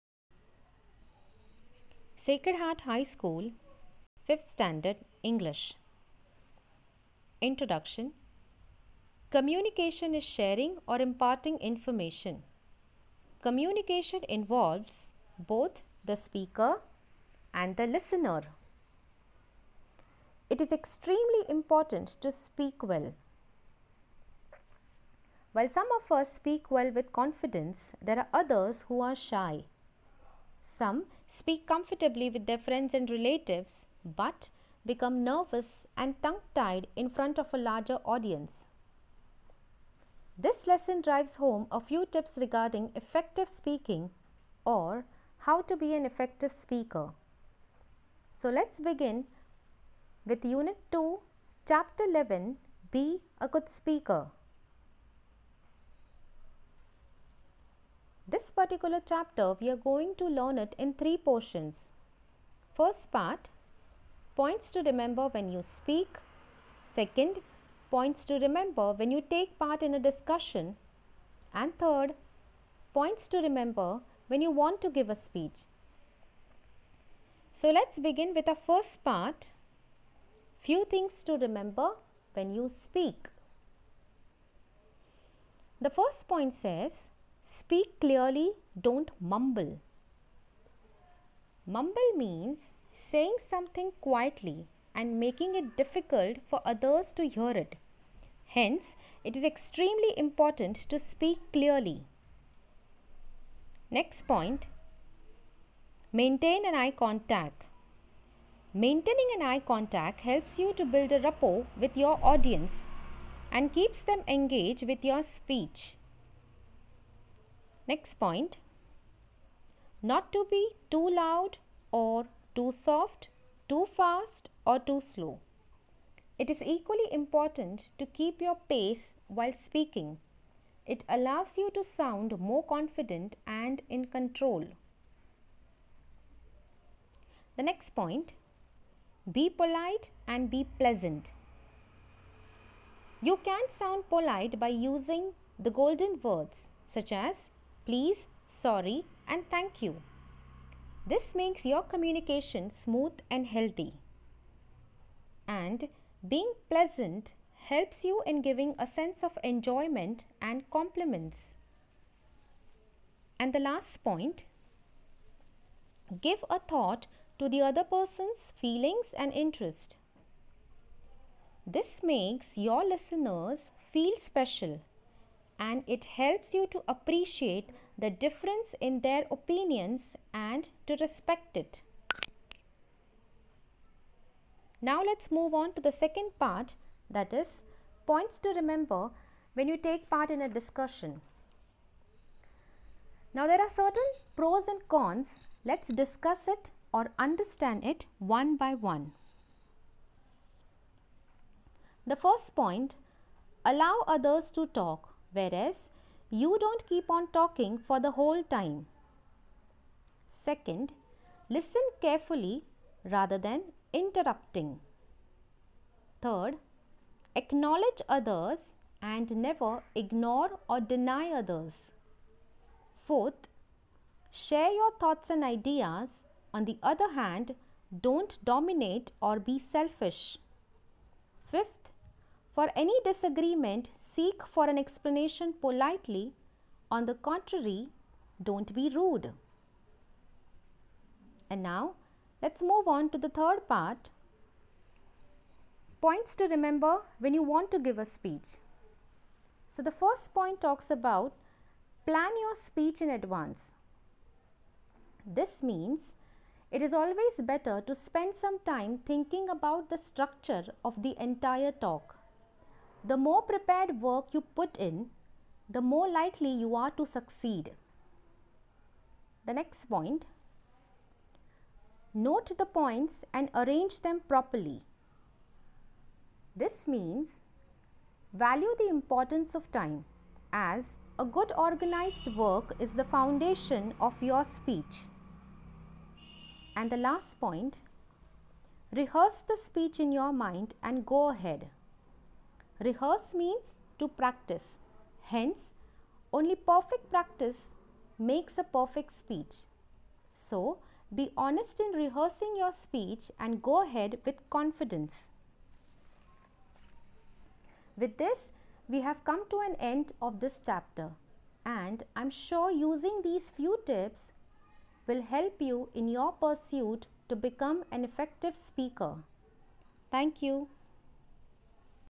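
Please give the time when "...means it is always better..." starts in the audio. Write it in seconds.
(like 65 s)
255 s.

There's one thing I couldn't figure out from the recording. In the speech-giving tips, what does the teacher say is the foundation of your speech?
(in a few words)
Good organized work.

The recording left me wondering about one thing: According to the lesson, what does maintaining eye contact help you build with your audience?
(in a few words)
A rapport.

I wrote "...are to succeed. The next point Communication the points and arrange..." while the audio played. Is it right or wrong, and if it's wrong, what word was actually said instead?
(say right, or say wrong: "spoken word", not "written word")
wrong: "Note", not "Communication".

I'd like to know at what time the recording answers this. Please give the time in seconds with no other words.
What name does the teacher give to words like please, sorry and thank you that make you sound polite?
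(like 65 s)
145 s.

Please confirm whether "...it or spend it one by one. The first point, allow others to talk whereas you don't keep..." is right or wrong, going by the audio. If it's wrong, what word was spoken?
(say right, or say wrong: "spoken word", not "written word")
wrong: "understand", not "spend".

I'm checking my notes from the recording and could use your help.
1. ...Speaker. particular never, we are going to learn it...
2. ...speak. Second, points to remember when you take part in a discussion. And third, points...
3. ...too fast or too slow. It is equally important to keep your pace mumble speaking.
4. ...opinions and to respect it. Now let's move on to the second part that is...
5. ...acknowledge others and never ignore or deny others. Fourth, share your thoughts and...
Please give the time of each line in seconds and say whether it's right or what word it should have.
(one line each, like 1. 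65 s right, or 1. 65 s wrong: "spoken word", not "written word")
1. 53 s wrong: "chapter", not "never"
2. 65 s right
3. 123 s wrong: "while", not "mumble"
4. 179 s right
5. 217 s right.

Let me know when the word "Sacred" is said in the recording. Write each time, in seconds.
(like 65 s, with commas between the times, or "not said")
2 s.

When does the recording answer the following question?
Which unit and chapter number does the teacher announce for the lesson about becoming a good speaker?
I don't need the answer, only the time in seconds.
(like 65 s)
50 s.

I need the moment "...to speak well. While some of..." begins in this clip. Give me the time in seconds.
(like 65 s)
22 s.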